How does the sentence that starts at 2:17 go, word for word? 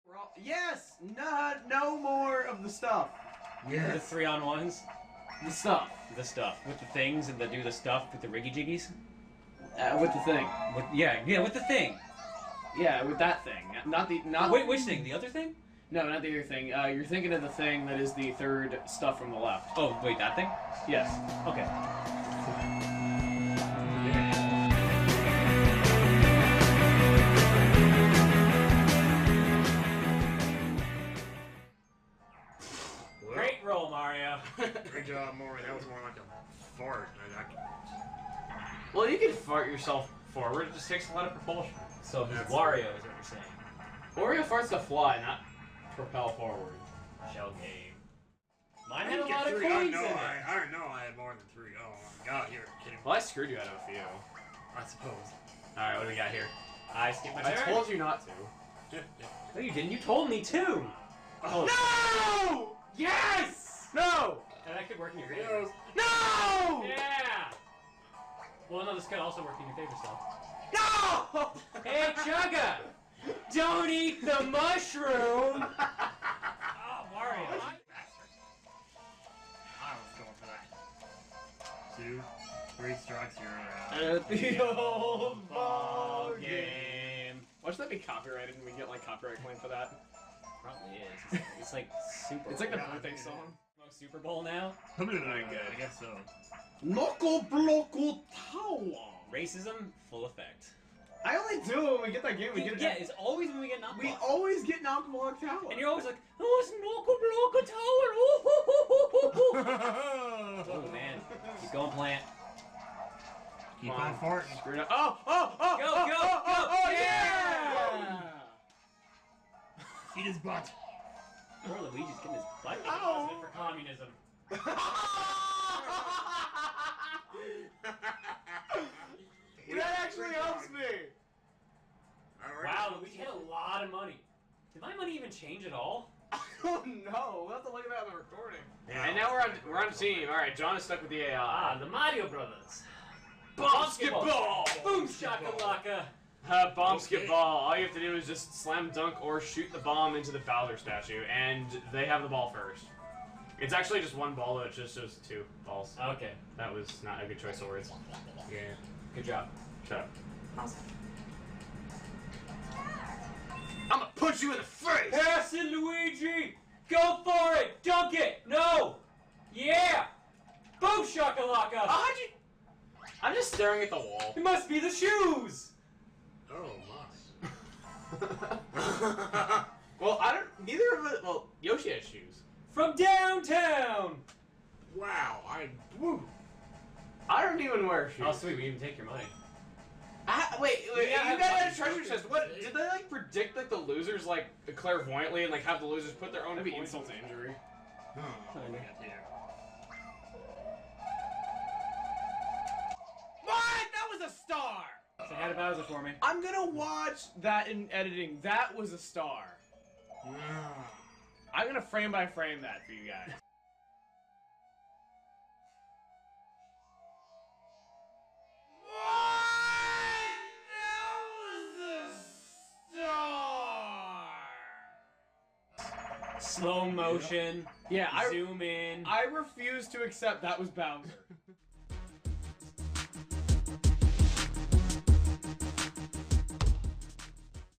We'll have to look at that on the recording.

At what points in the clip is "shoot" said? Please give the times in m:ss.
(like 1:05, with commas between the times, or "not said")
2:29.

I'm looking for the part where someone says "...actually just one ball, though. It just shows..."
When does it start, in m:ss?
2:33.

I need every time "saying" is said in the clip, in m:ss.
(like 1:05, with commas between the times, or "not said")
0:44.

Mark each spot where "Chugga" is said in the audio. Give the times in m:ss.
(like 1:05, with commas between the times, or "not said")
1:12.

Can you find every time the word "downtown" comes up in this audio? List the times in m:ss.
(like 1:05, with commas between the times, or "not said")
3:02.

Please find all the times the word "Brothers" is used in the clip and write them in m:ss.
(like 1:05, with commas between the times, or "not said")
2:22.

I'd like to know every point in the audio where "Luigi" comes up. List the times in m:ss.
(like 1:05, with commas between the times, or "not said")
2:01, 2:12, 2:45.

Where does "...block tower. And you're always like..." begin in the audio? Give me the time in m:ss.
1:45.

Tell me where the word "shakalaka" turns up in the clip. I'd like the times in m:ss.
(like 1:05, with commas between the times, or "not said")
2:25, 2:51.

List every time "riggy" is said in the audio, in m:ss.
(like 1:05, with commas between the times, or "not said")
0:08.